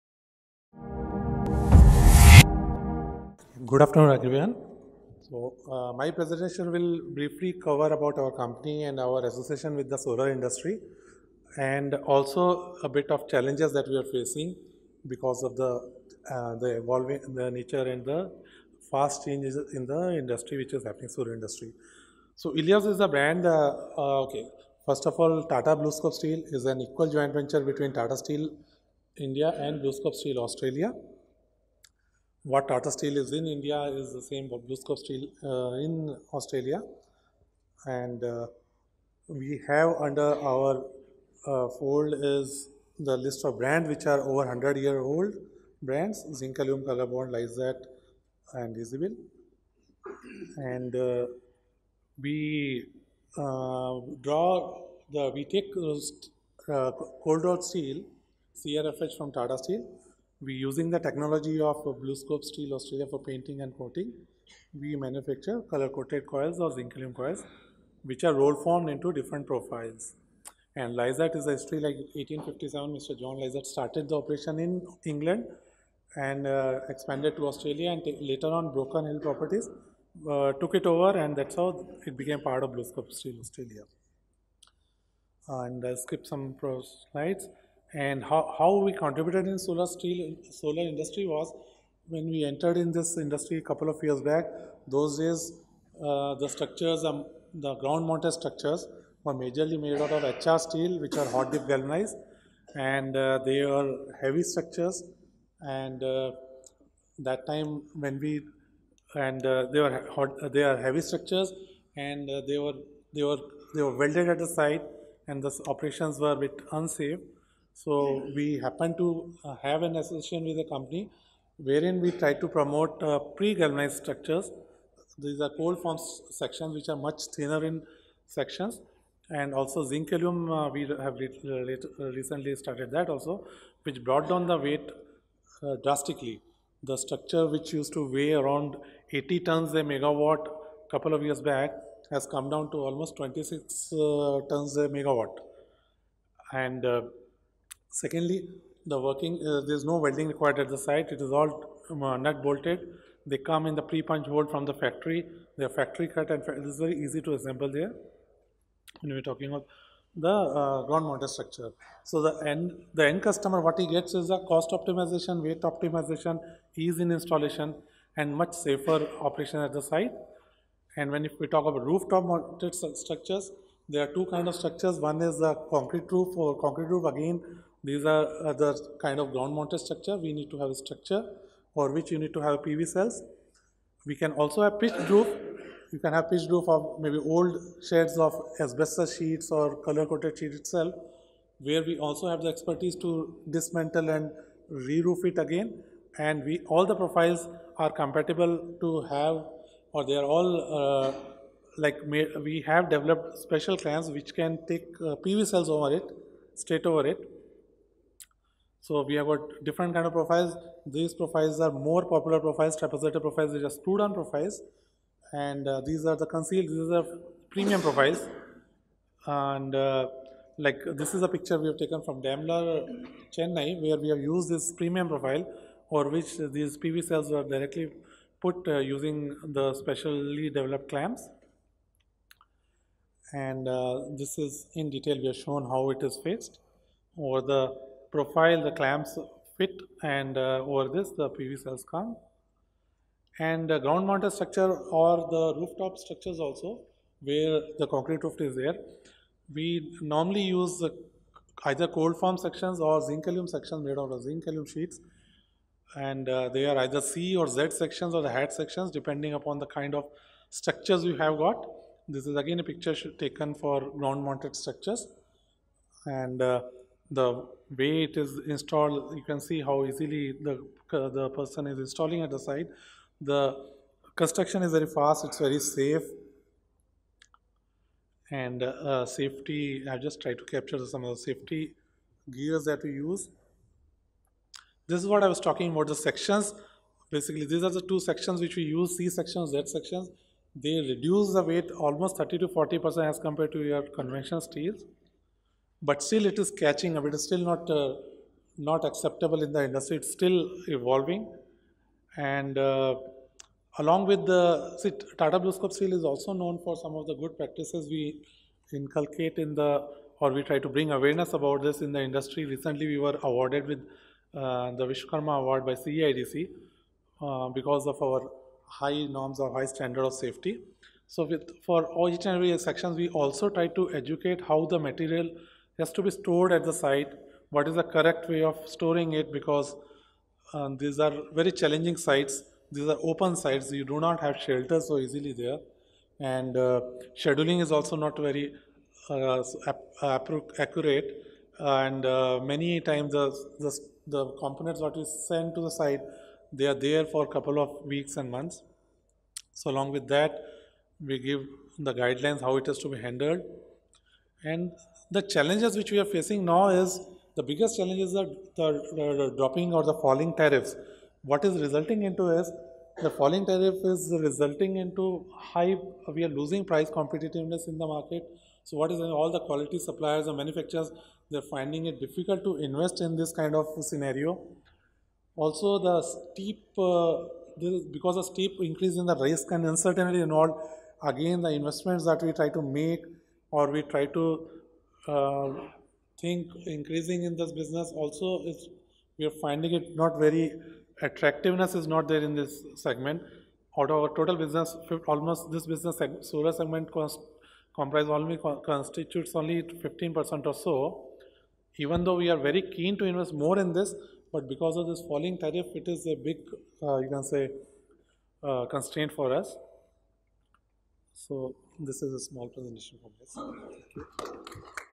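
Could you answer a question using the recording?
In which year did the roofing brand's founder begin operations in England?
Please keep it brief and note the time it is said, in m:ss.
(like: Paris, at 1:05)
1857, at 1:12.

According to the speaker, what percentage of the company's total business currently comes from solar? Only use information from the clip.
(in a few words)
15%.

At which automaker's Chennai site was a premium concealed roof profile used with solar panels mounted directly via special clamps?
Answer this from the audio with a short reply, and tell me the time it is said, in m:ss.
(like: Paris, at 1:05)
Daimler, at 3:42.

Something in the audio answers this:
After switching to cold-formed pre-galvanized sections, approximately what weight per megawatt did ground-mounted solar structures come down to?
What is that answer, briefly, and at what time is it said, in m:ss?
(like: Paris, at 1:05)
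26 tons, at 2:23.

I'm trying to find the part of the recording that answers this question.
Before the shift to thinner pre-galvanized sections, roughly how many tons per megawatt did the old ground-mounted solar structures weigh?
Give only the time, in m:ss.
2:19.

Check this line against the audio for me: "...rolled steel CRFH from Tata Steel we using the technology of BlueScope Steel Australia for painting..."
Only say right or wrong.
right.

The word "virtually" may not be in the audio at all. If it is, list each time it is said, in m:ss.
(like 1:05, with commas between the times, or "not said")
not said.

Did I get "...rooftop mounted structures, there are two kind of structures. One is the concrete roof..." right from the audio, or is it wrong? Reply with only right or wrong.
right.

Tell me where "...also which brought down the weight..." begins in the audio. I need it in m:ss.
2:13.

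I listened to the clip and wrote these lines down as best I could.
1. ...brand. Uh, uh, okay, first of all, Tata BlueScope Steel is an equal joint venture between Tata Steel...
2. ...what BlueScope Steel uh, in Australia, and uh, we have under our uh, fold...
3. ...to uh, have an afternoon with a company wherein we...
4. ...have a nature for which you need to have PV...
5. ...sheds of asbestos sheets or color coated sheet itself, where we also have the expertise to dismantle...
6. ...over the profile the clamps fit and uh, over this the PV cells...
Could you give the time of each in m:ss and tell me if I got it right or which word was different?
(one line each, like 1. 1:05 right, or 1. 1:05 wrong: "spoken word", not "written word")
1. 0:23 right
2. 0:34 right
3. 1:58 wrong: "association", not "afternoon"
4. 3:00 wrong: "structure", not "nature"
5. 3:07 right
6. 3:57 right.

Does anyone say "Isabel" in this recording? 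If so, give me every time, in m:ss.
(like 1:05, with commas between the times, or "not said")
0:48.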